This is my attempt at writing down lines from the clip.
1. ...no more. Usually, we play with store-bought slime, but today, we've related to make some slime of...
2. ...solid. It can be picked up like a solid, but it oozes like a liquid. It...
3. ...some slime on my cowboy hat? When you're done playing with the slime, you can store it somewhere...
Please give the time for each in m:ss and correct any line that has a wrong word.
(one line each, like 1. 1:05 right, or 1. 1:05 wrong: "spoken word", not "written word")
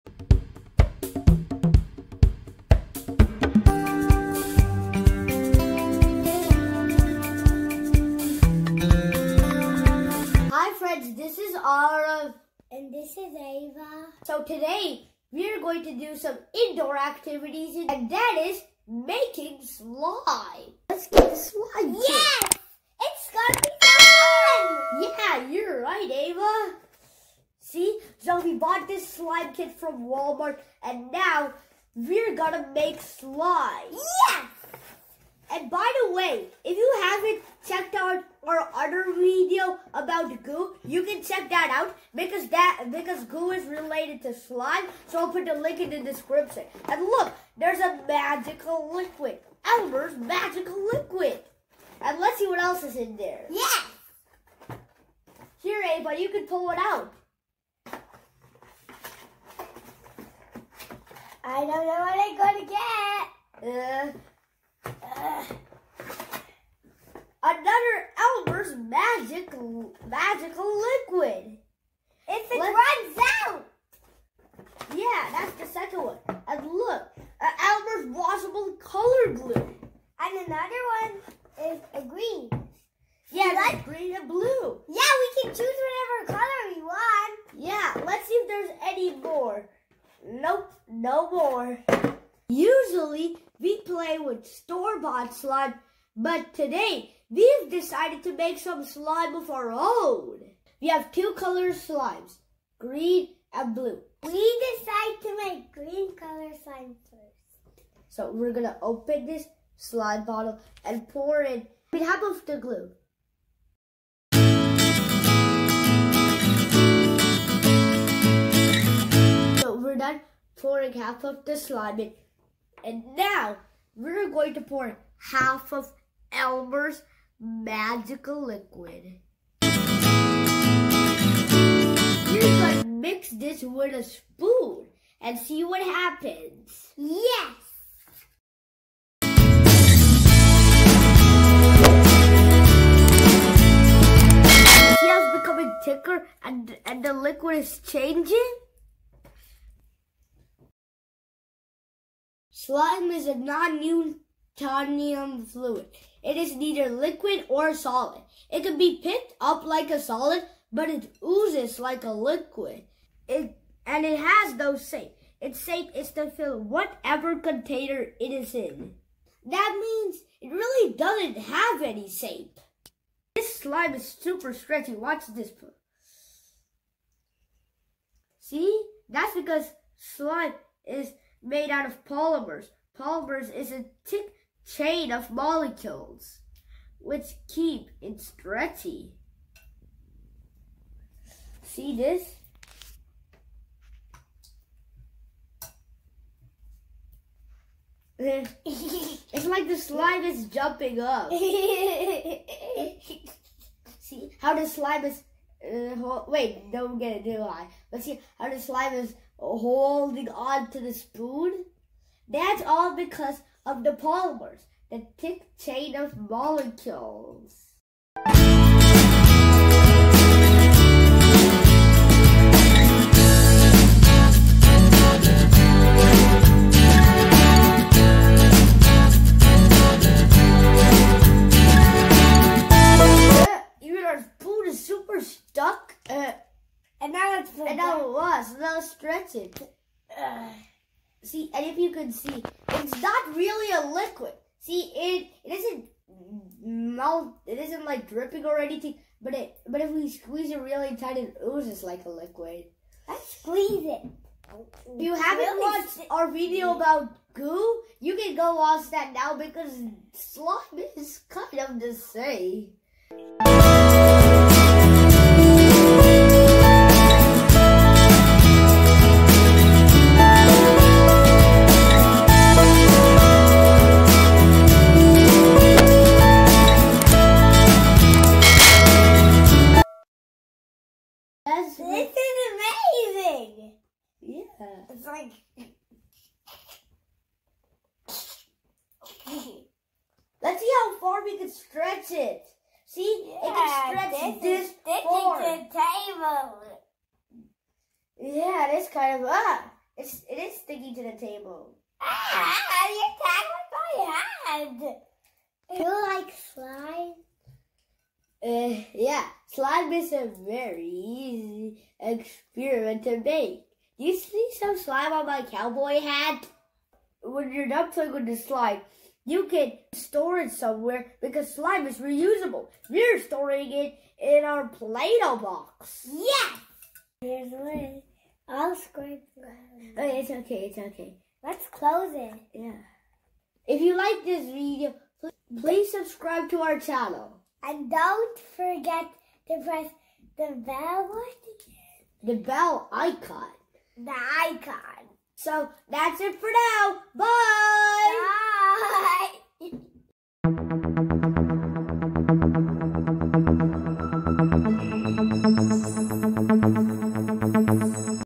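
1. 1:30 wrong: "decided", not "related"
2. 2:37 right
3. 5:14 right.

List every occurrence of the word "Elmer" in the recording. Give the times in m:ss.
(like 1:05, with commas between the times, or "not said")
0:49, 1:08, 1:17, 2:06.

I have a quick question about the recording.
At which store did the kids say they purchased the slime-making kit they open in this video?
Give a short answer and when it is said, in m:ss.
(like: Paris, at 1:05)
Walmart, at 0:30.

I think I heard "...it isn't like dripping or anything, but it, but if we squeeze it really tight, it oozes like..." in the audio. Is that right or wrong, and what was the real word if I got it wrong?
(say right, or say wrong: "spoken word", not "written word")
right.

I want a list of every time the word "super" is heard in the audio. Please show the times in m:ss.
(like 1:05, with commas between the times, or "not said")
2:54, 3:54.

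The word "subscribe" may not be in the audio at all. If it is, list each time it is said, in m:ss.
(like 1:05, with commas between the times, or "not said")
5:35.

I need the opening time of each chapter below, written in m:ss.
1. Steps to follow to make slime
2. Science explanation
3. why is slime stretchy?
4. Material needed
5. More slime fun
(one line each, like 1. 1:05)
1. 1:40
2. 2:30
3. 2:55
4. 0:20
5. 4:23.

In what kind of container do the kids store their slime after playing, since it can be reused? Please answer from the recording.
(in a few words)
Play-Doh box.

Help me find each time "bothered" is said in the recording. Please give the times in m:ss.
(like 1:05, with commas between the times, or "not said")
not said.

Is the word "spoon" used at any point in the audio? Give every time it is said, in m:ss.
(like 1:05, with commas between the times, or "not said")
2:14, 3:30, 3:54.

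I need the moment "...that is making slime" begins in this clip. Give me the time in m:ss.
0:18.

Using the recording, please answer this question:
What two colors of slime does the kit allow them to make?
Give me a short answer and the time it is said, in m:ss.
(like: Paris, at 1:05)
green and blue, at 1:42.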